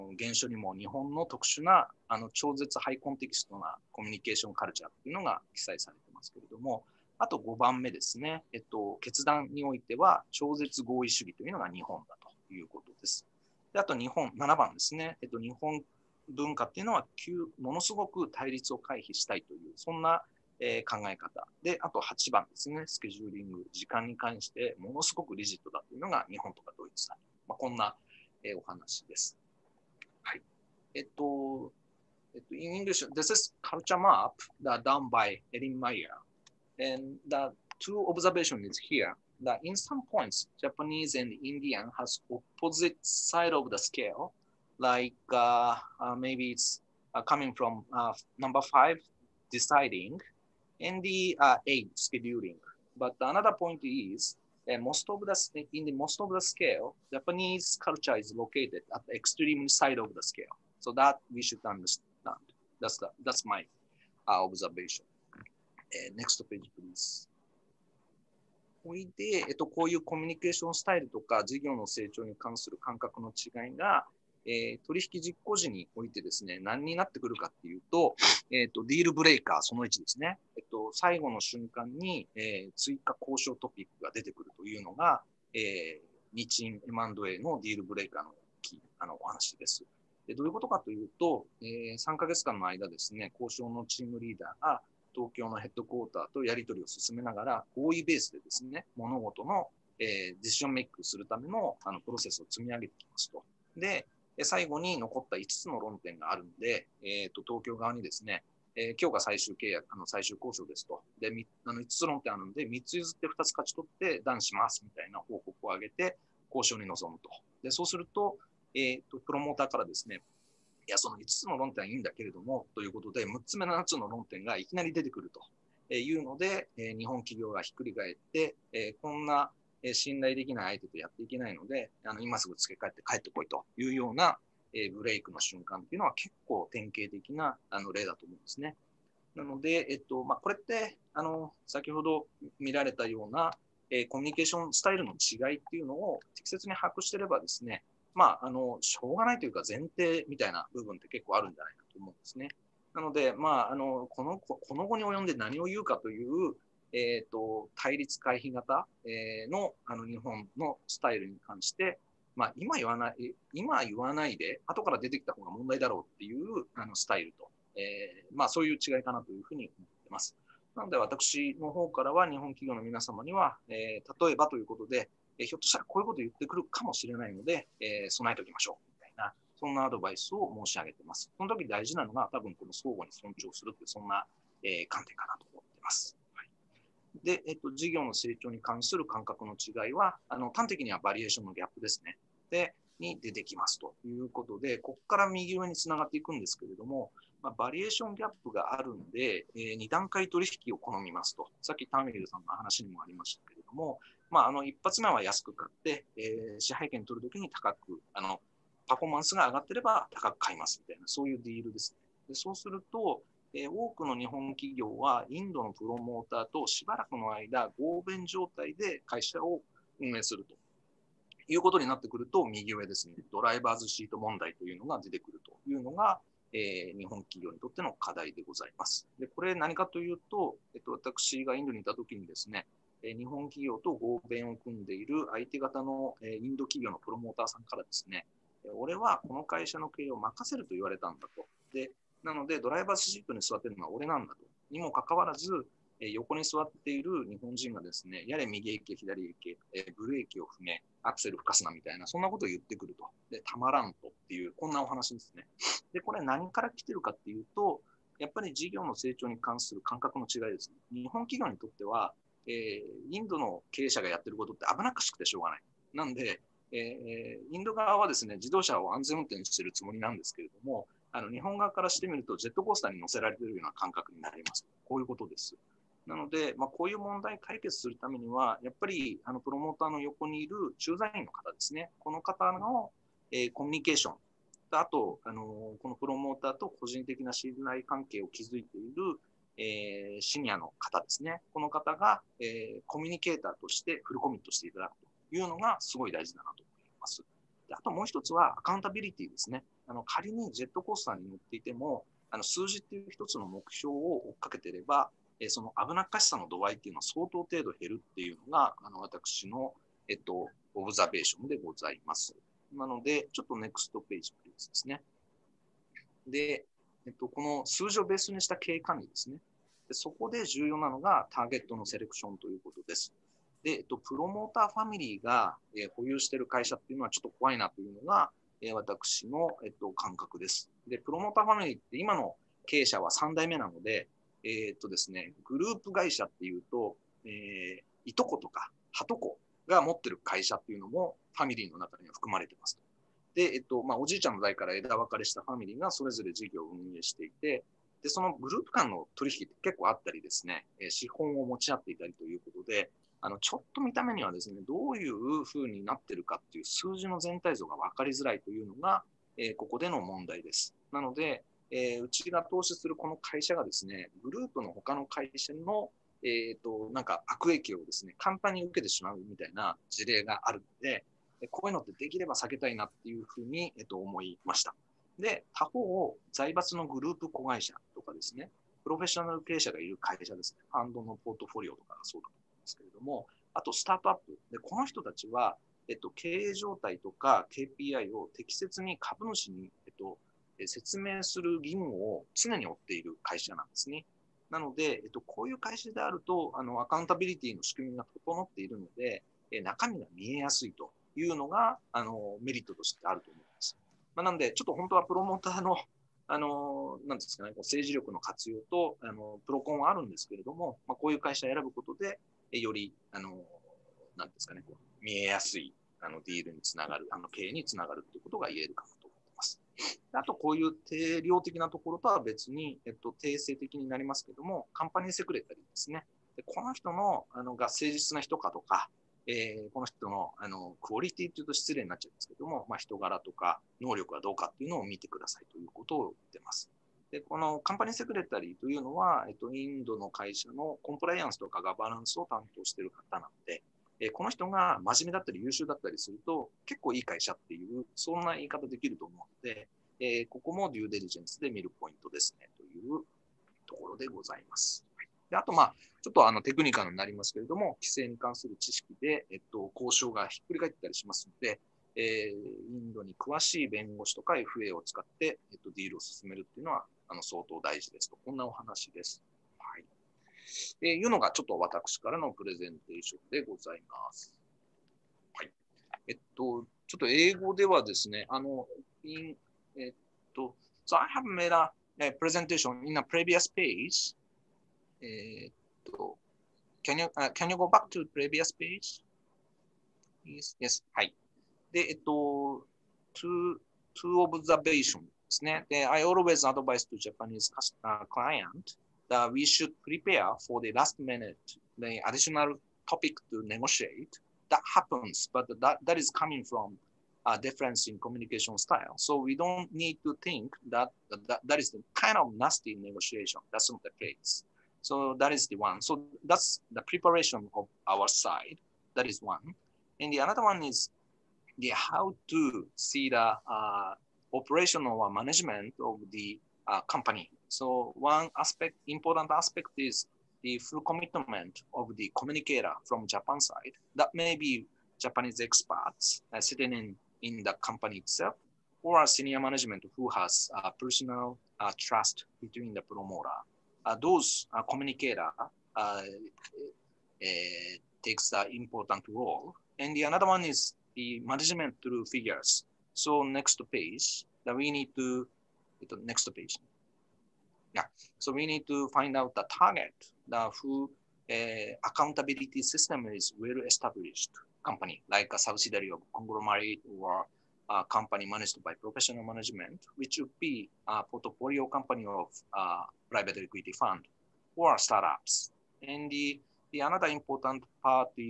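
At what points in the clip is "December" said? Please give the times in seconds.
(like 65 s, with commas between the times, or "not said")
not said.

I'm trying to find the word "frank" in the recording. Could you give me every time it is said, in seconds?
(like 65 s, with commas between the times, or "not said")
not said.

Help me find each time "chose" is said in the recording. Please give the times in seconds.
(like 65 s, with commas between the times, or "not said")
not said.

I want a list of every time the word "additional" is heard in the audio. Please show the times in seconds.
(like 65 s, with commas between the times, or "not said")
502 s.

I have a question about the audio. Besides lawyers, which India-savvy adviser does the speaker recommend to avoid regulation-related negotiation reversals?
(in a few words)
FA.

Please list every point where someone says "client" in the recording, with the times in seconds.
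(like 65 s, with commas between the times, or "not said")
498 s.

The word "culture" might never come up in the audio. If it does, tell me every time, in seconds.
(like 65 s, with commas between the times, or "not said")
33 s, 57 s.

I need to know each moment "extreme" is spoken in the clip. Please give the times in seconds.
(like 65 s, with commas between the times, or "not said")
59 s.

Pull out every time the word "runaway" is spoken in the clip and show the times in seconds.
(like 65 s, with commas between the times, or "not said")
not said.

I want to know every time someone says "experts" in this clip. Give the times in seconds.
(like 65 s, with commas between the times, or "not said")
535 s.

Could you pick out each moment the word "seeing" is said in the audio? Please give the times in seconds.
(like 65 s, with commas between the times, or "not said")
not said.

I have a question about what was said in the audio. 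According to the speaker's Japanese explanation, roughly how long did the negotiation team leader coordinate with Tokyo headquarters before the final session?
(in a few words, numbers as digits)
3 months.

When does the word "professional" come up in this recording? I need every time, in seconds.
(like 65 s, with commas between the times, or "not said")
568 s.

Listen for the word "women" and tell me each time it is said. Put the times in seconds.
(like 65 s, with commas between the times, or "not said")
not said.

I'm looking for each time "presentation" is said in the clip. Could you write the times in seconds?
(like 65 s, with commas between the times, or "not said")
482 s.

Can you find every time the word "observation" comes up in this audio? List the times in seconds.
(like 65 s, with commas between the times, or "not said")
38 s, 64 s, 494 s.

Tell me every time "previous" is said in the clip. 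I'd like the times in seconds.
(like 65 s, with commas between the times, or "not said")
483 s, 488 s.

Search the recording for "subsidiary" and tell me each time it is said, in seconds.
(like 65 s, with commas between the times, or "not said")
565 s.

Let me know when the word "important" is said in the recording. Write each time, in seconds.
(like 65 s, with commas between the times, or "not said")
528 s, 548 s, 577 s.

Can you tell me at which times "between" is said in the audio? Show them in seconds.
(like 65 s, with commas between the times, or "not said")
542 s.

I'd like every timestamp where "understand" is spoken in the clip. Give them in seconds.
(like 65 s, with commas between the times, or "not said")
61 s.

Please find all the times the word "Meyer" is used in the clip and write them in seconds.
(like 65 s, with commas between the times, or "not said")
35 s.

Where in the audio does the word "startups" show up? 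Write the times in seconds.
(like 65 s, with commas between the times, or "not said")
574 s.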